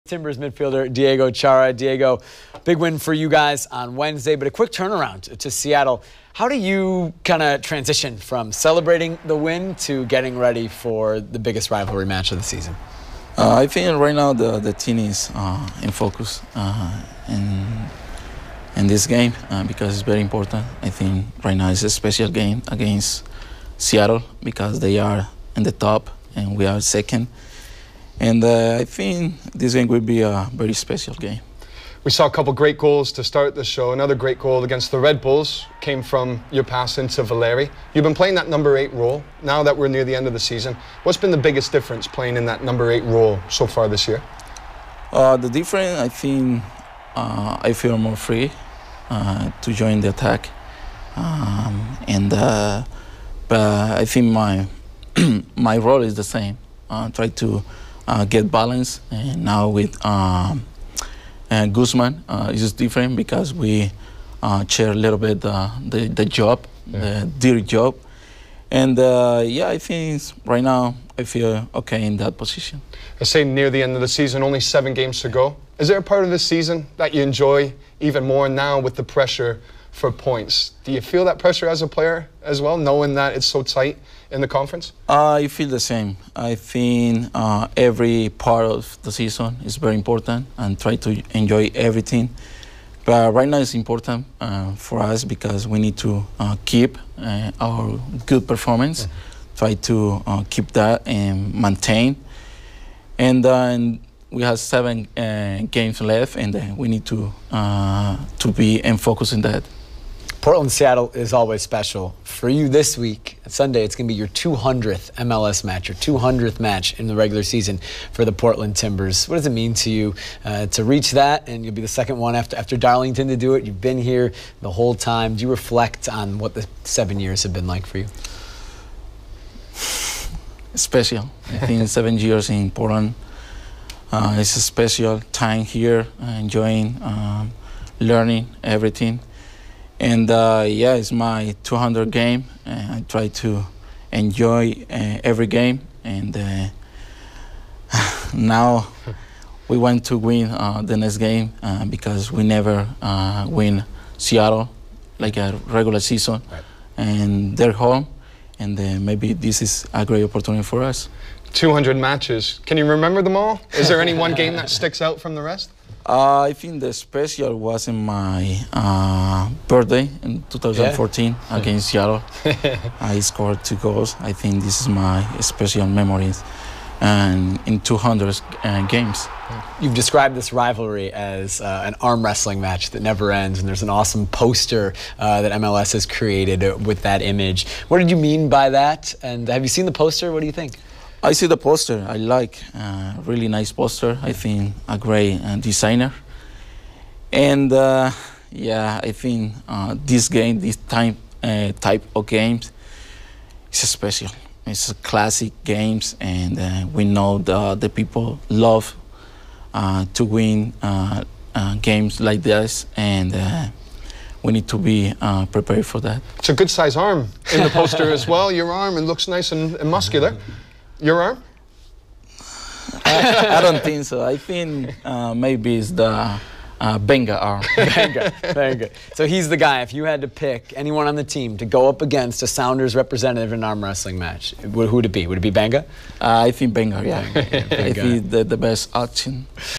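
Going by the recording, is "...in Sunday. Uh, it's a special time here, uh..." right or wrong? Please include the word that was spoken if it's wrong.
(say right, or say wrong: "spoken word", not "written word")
wrong: "Portland", not "Sunday".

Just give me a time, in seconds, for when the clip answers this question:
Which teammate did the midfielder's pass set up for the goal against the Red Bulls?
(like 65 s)
37 s.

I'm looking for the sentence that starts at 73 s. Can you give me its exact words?
I say near the end of the season, only seven games to go.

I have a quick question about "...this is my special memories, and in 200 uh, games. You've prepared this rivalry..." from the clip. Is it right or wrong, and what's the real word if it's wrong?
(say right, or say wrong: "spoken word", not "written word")
wrong: "described", not "prepared".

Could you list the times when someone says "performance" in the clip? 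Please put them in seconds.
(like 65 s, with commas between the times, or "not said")
98 s.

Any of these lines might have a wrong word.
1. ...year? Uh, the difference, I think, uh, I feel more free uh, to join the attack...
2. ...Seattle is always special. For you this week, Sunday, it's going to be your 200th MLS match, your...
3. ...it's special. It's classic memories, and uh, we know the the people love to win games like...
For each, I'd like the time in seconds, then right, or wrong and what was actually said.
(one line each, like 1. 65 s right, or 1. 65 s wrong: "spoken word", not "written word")
1. 44 s right
2. 110 s right
3. 203 s wrong: "games", not "memories".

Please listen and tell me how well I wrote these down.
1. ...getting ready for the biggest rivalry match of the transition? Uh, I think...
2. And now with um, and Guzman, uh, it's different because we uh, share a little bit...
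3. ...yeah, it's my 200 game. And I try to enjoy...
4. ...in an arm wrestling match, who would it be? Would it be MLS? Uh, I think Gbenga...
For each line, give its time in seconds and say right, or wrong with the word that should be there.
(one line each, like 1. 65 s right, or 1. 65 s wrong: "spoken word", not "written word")
1. 10 s wrong: "season", not "transition"
2. 59 s right
3. 140 s right
4. 233 s wrong: "Gbenga", not "MLS".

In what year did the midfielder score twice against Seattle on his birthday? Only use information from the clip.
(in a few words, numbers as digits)
2014.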